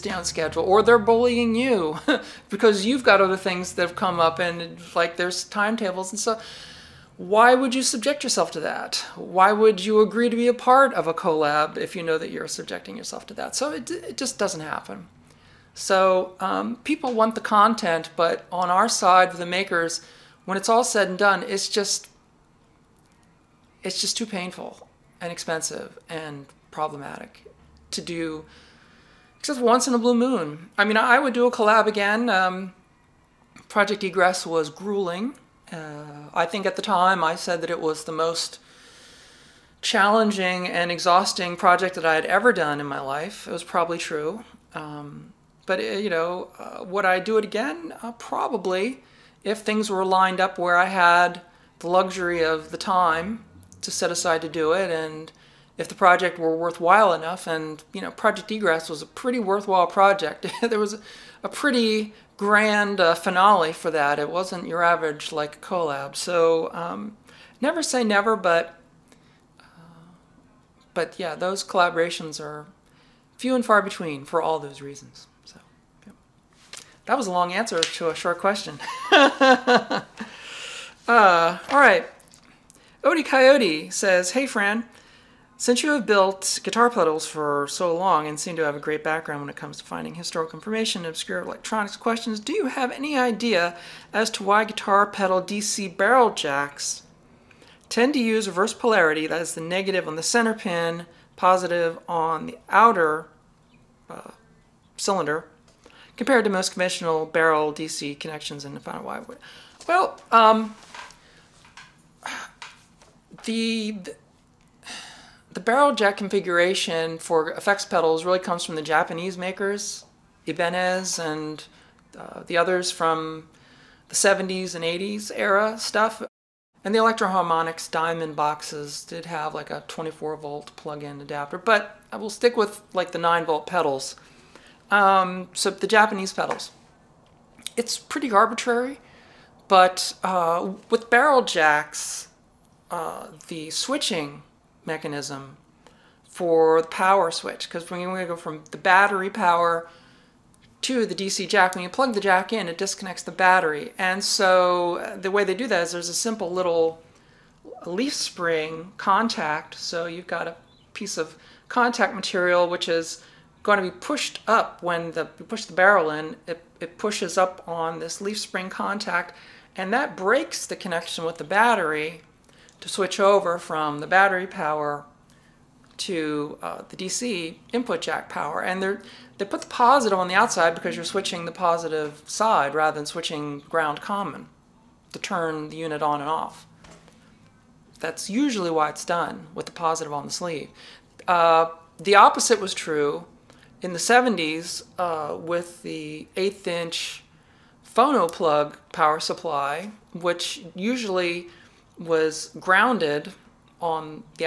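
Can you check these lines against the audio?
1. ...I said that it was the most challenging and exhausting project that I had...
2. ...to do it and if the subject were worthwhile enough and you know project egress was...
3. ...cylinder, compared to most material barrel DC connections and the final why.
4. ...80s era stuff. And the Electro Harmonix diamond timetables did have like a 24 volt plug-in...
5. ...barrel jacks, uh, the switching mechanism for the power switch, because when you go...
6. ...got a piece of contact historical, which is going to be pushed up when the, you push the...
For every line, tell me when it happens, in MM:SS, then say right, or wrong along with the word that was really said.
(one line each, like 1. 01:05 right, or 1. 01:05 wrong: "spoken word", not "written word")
1. 00:37 right
2. 00:54 wrong: "project", not "subject"
3. 01:44 wrong: "conventional", not "material"
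4. 02:04 wrong: "boxes", not "timetables"
5. 02:21 right
6. 02:40 wrong: "material", not "historical".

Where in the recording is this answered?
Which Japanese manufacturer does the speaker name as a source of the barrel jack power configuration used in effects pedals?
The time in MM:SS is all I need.
02:00.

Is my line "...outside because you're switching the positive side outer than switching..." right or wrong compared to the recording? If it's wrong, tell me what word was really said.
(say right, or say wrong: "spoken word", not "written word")
wrong: "rather", not "outer".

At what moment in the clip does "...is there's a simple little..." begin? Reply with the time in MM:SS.
02:35.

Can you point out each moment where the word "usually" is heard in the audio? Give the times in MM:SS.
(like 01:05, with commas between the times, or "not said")
03:08, 03:20.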